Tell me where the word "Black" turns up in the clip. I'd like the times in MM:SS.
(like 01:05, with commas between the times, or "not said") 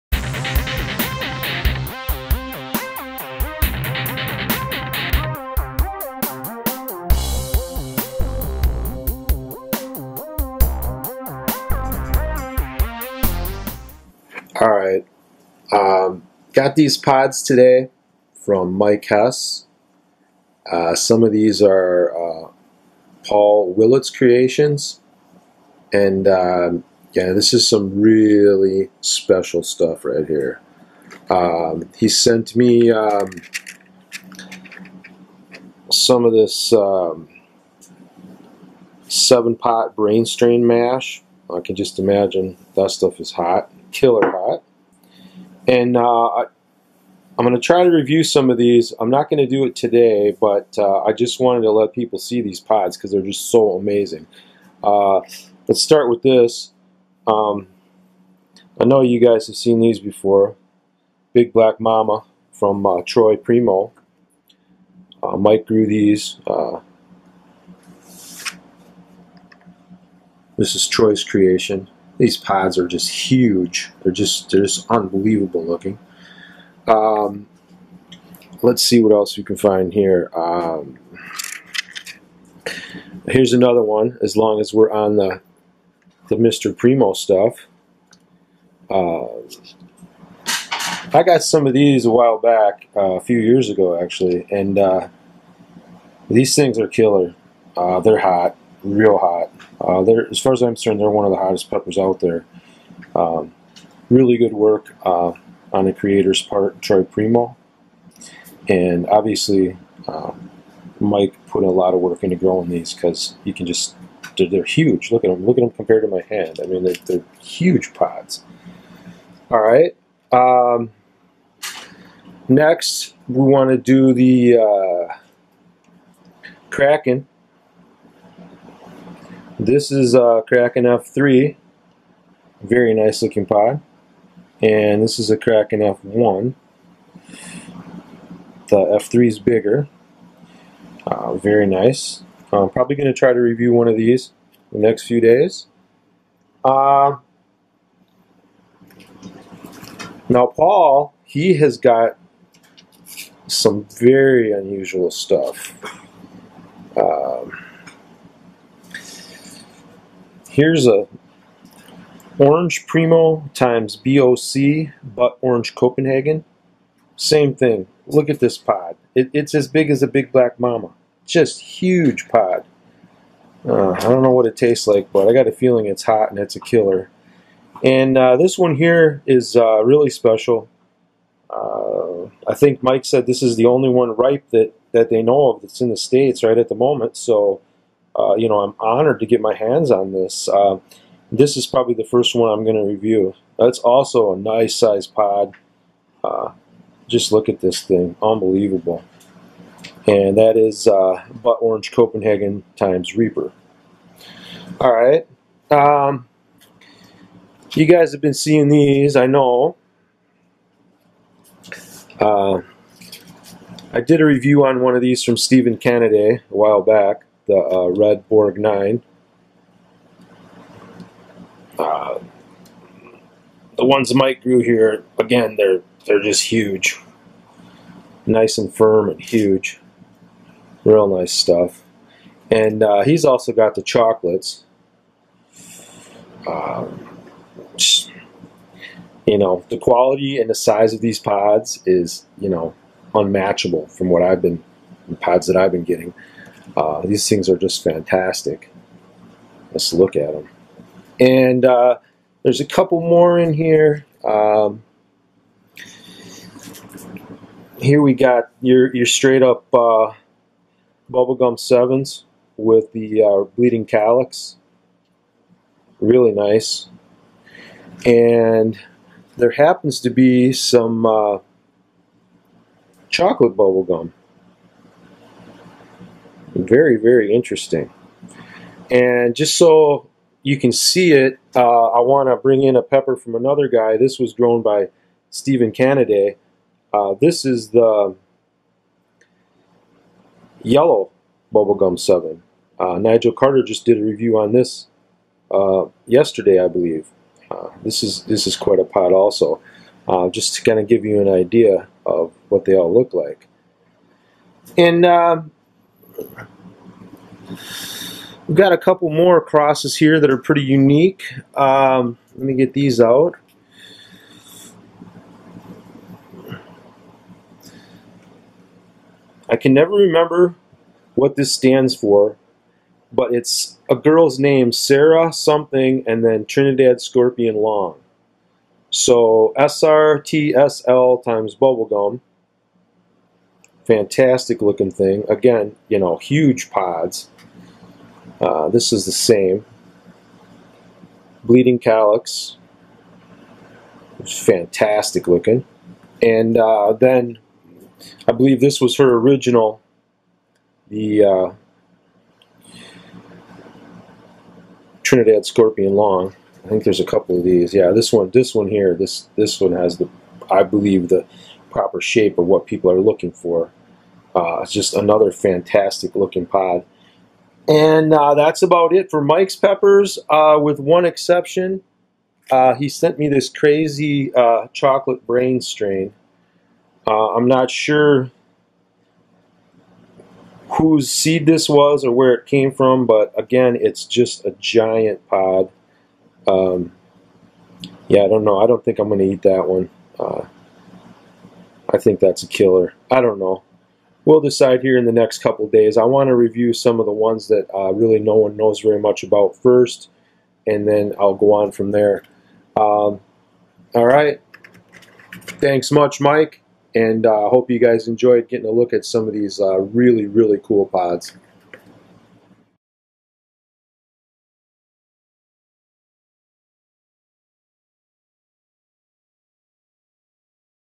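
01:01, 02:50.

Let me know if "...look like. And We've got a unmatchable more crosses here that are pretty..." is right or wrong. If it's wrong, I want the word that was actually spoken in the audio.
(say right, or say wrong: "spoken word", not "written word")
wrong: "couple", not "unmatchable".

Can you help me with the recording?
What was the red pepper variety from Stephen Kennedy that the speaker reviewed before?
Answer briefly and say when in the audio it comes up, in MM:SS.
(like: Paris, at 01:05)
red Borg 9, at 03:37.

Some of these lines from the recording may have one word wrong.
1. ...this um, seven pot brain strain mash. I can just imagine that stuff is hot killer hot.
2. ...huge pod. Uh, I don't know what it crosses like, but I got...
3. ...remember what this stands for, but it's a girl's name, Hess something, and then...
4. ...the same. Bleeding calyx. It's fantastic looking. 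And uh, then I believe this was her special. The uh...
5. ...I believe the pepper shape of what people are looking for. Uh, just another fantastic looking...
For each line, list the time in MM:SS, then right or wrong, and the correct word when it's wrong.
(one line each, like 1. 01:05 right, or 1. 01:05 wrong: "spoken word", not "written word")
1. 00:36 right
2. 02:51 wrong: "tastes", not "crosses"
3. 05:19 wrong: "Sarah", not "Hess"
4. 05:39 wrong: "original", not "special"
5. 06:00 wrong: "proper", not "pepper".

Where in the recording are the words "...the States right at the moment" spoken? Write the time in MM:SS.
03:05.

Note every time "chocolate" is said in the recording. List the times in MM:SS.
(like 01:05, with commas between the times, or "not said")
03:53, 04:33, 06:14.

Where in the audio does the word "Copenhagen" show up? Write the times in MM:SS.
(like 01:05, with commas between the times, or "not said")
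02:45, 03:21.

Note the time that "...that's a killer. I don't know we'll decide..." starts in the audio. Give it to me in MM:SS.
06:32.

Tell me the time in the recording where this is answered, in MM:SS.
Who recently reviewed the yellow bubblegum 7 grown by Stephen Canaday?
04:52.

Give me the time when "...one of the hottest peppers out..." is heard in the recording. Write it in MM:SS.
01:41.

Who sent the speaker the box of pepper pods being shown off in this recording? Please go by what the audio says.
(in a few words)
Mike Hess.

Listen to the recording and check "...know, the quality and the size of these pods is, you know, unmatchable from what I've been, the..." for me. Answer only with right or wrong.
right.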